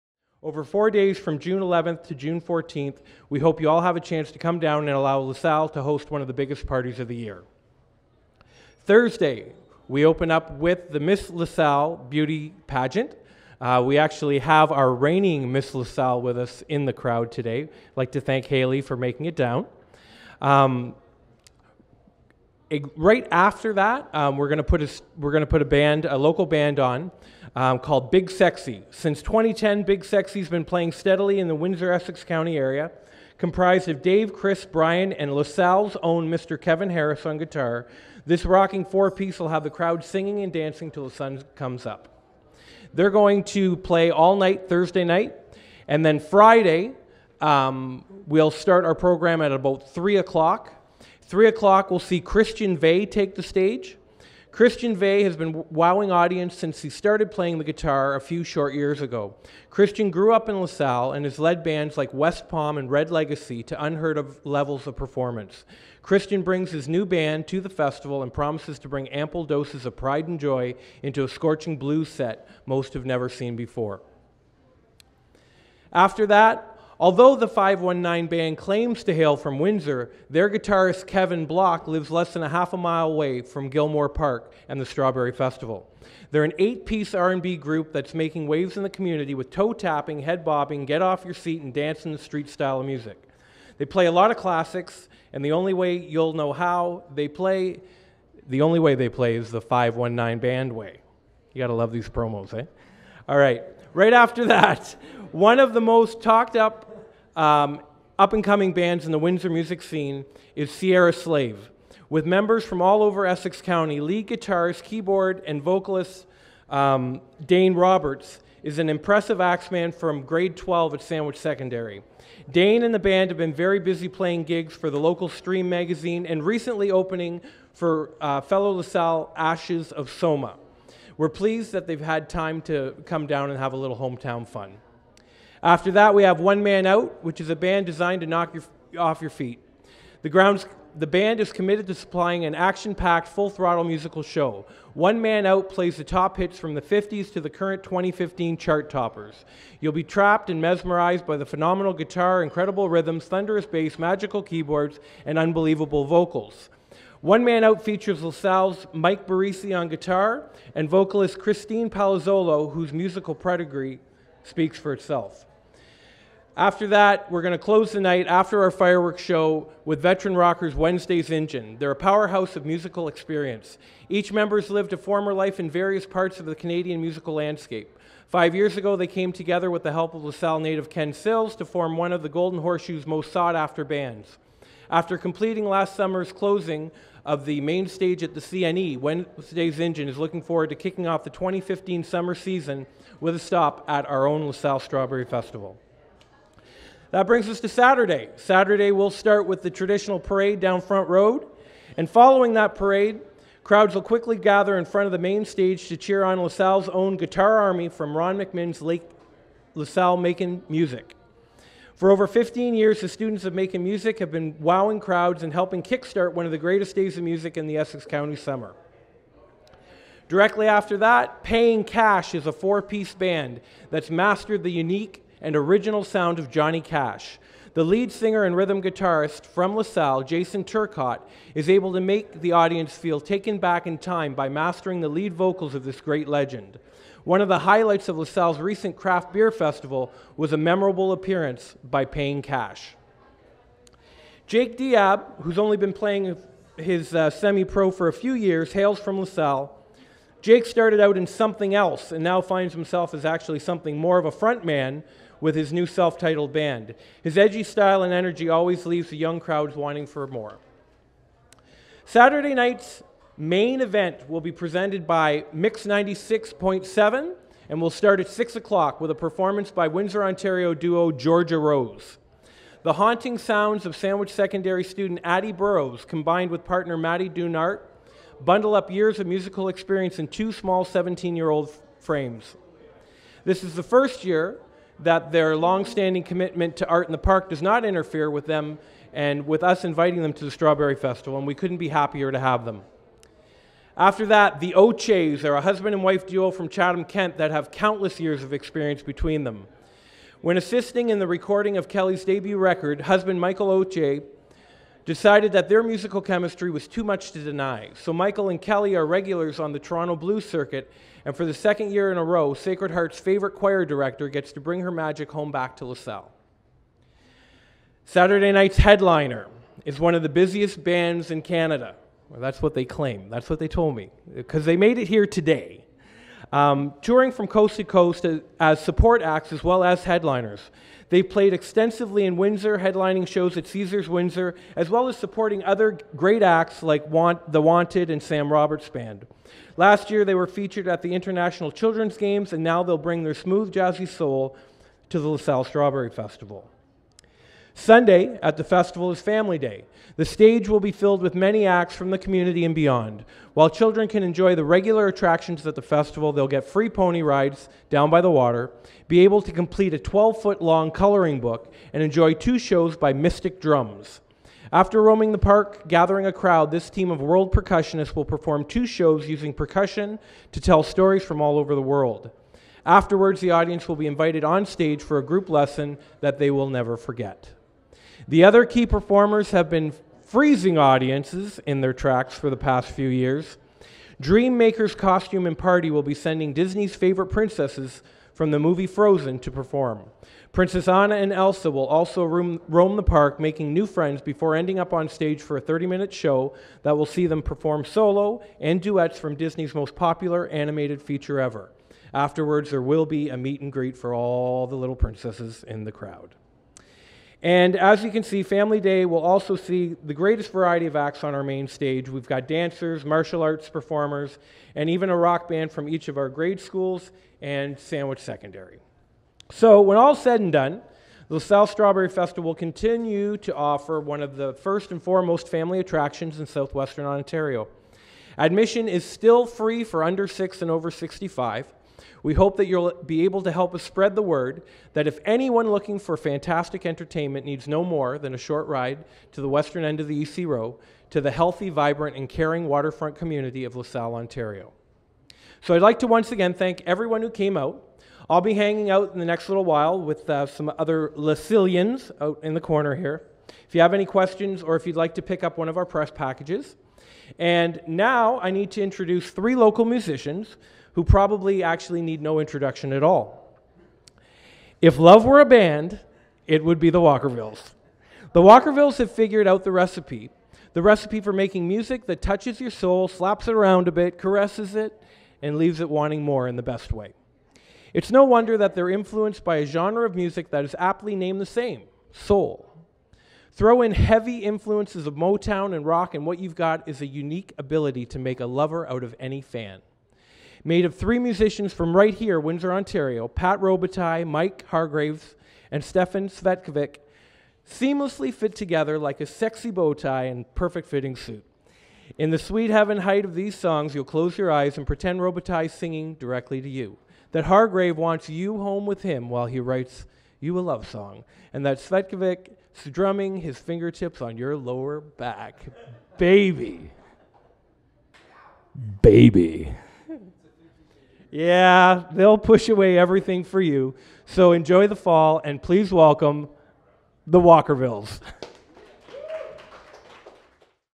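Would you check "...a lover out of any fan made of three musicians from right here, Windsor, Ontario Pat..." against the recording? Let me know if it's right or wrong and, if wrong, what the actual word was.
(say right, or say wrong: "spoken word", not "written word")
right.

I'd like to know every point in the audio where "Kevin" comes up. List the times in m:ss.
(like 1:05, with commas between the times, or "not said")
0:36, 1:21.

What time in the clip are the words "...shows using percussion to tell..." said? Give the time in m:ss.
6:08.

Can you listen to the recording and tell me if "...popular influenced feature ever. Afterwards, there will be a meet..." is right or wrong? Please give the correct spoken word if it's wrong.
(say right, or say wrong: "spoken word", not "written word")
wrong: "animated", not "influenced".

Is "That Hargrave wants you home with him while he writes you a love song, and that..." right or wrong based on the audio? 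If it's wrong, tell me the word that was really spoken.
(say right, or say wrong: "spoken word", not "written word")
right.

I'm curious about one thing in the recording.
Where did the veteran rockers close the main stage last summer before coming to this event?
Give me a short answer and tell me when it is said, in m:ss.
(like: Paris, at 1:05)
the CNE, at 3:08.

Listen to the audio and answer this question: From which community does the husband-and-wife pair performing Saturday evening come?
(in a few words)
Chatham, Kent.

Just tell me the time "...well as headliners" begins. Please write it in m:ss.
5:29.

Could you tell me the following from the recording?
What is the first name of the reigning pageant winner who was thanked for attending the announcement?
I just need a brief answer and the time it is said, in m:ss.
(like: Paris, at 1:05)
Haley, at 0:18.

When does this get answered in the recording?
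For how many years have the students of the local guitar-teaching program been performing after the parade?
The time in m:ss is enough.
3:32.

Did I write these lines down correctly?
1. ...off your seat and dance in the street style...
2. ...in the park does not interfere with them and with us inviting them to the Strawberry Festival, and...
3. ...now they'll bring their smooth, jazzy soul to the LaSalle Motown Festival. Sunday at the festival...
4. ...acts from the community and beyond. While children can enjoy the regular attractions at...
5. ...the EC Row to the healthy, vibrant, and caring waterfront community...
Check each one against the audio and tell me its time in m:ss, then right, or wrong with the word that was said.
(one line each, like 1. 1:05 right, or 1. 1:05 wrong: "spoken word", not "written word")
1. 1:31 right
2. 4:47 right
3. 5:42 wrong: "Strawberry", not "Motown"
4. 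5:51 right
5. 7:20 right.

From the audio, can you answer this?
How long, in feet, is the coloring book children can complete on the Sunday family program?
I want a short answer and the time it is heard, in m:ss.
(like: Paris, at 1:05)
12, at 5:59.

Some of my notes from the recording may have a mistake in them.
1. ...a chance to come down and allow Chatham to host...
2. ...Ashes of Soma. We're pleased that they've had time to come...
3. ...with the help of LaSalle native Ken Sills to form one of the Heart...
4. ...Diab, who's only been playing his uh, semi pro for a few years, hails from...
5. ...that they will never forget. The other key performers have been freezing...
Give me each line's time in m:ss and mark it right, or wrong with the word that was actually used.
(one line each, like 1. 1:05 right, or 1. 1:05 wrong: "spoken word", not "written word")
1. 0:03 wrong: "LaSalle", not "Chatham"
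2. 2:09 right
3. 2:59 wrong: "Golden", not "Heart"
4. 4:04 right
5. 6:16 right.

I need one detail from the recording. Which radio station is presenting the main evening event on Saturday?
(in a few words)
Mix 96.7.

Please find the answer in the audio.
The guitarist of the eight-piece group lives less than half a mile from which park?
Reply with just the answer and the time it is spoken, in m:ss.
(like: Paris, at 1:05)
Gilmore Park, at 1:23.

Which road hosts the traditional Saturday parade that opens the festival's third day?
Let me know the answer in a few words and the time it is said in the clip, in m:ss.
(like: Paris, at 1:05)
Front Road, at 3:20.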